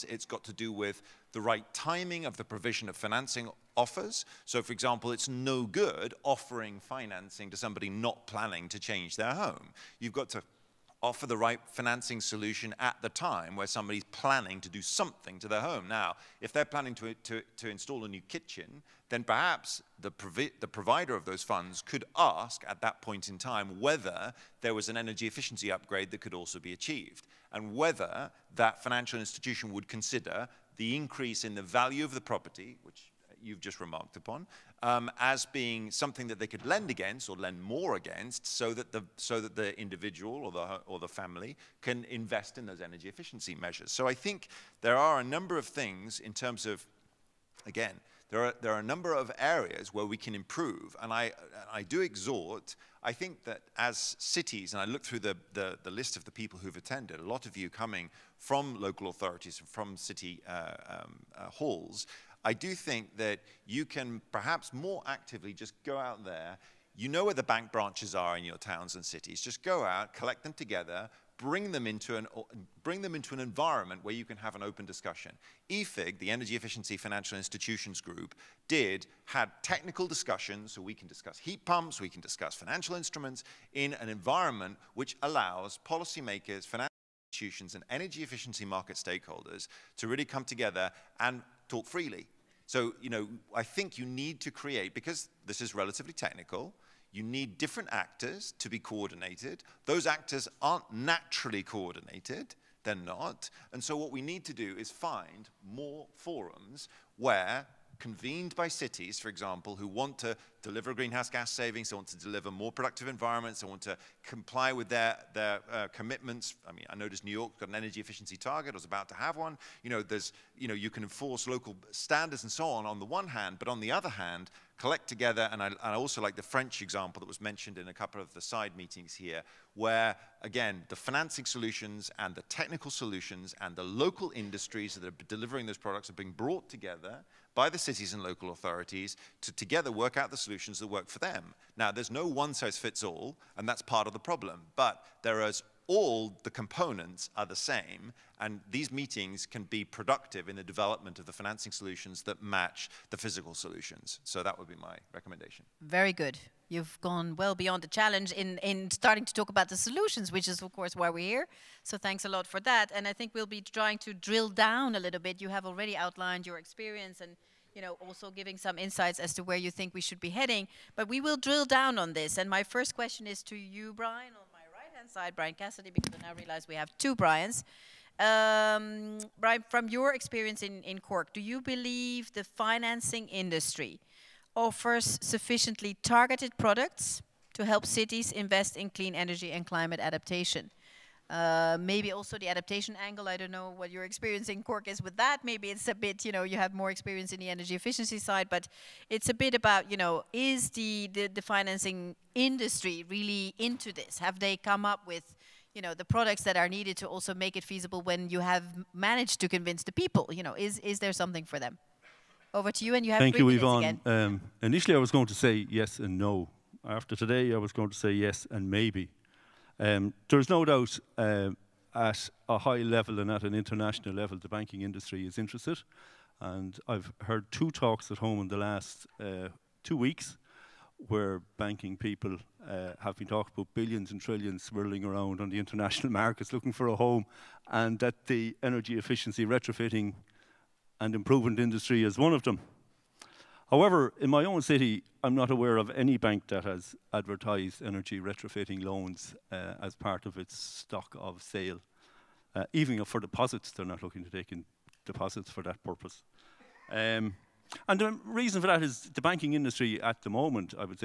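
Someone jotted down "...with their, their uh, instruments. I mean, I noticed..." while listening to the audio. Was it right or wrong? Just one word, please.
wrong.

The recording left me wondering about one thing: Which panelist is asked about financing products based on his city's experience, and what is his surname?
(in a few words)
Cassidy.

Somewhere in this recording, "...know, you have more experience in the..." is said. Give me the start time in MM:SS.
03:16.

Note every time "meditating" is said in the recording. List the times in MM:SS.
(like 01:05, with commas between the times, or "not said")
not said.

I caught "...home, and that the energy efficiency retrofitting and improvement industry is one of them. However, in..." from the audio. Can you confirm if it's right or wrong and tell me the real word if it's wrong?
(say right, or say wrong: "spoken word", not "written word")
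right.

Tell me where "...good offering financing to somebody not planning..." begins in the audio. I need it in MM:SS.
00:05.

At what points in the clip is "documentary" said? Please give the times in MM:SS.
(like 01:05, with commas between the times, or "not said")
not said.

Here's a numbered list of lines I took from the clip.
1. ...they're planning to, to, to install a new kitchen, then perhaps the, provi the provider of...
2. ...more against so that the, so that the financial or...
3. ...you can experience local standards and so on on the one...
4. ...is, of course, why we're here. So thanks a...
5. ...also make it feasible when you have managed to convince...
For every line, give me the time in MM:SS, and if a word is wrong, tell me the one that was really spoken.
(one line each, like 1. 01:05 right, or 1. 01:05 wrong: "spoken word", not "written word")
1. 00:16 right
2. 00:37 wrong: "individual", not "financial"
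3. 02:00 wrong: "enforce", not "experience"
4. 02:40 right
5. 03:27 right.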